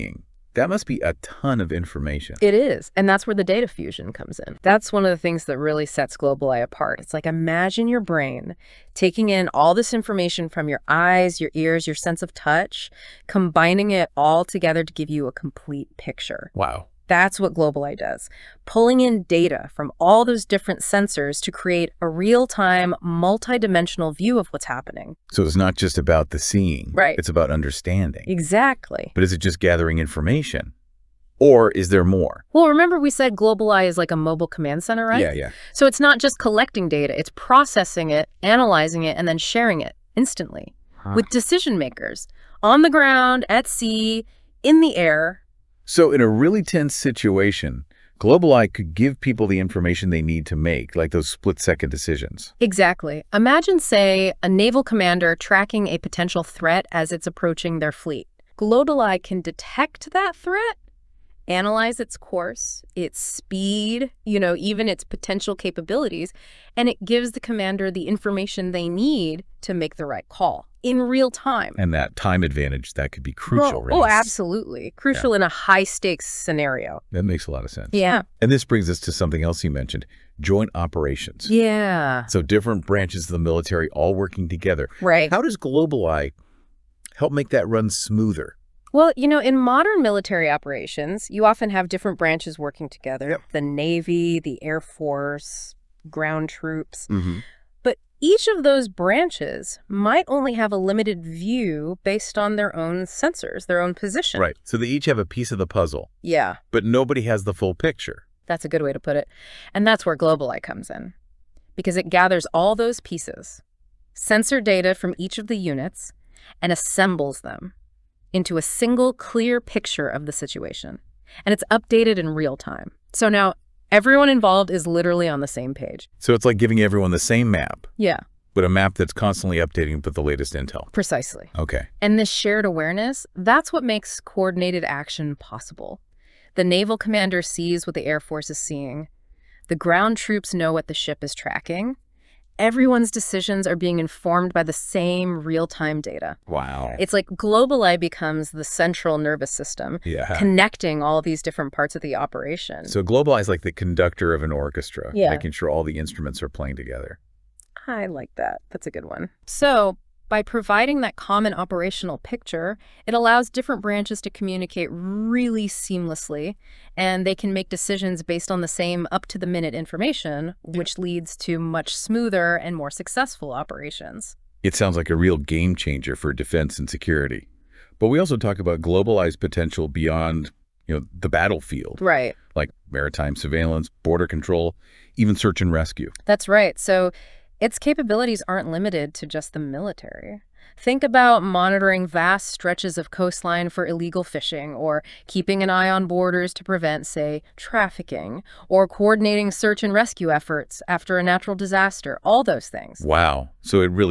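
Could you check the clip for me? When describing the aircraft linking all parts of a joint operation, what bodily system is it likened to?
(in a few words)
Central nervous system.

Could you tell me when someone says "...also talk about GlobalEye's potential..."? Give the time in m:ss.
2:58.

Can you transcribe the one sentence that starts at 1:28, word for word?
Well, you know, in modern military operations, you often have different branches working together yep.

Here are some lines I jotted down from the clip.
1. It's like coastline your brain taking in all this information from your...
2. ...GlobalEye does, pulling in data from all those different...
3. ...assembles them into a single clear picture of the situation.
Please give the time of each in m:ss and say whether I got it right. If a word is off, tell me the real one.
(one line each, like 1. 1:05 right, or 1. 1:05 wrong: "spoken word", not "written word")
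1. 0:06 wrong: "imagine", not "coastline"
2. 0:17 right
3. 1:56 right.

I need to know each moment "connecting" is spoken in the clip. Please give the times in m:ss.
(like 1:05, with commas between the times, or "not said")
2:30.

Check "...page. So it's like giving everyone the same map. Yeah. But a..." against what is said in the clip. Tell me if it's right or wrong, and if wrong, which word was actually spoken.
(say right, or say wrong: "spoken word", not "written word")
right.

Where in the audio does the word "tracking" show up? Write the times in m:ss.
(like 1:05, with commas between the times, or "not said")
0:55, 2:21.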